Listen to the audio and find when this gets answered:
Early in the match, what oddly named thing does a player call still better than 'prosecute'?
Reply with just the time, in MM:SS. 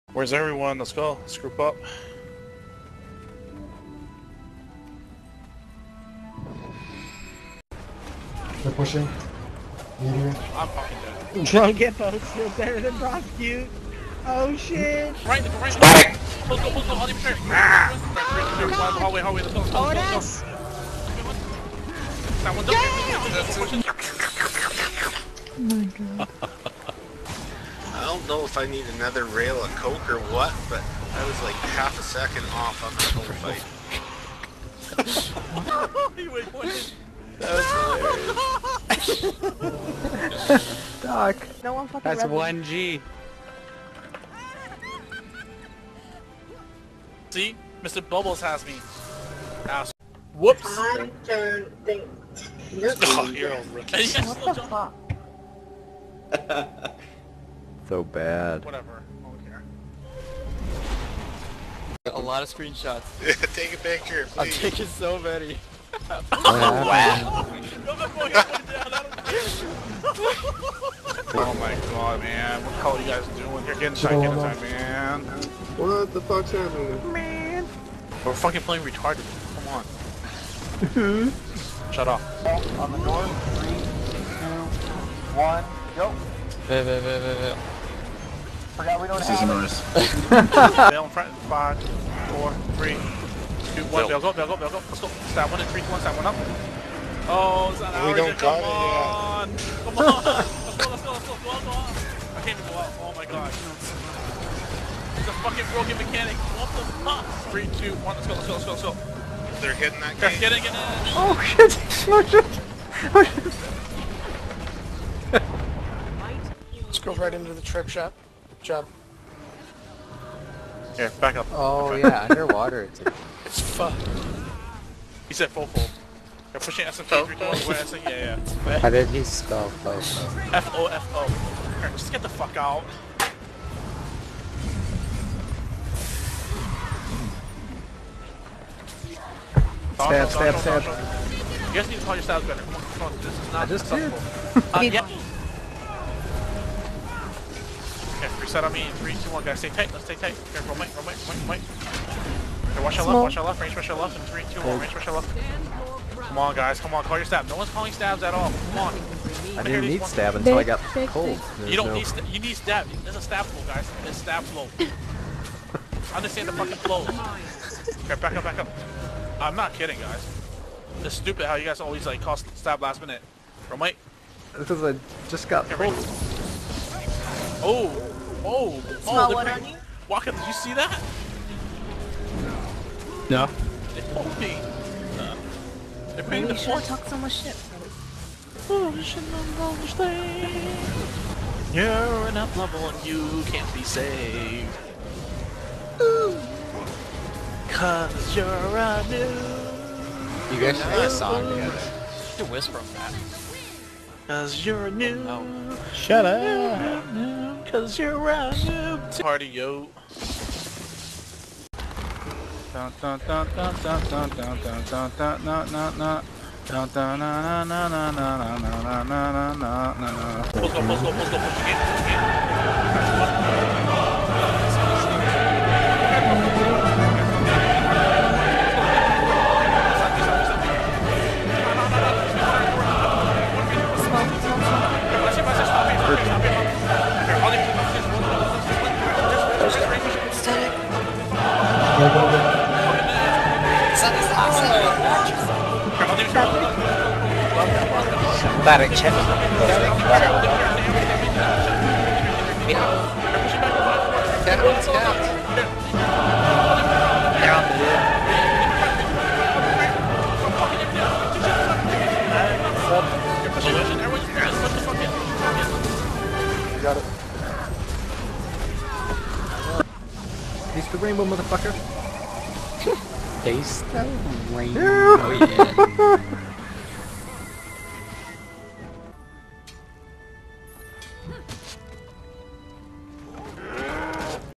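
00:11.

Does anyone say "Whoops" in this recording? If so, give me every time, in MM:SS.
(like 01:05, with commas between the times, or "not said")
00:50.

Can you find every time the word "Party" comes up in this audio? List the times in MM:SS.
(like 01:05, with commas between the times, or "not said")
03:29.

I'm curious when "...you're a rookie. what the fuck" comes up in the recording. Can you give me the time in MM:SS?
00:53.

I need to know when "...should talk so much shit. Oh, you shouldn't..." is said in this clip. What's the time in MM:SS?
03:06.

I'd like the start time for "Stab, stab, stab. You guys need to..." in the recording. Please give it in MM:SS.
02:20.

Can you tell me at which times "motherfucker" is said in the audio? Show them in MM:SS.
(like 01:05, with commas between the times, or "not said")
04:31.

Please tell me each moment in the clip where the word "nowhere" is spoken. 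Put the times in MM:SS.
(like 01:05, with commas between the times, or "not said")
not said.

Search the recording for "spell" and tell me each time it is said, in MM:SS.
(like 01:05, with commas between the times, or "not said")
02:09.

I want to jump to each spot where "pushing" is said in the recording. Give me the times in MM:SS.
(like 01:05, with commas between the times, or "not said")
00:08, 02:06.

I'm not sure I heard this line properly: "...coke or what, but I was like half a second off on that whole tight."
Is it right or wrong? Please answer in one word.
wrong.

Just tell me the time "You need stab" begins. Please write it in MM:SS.
02:42.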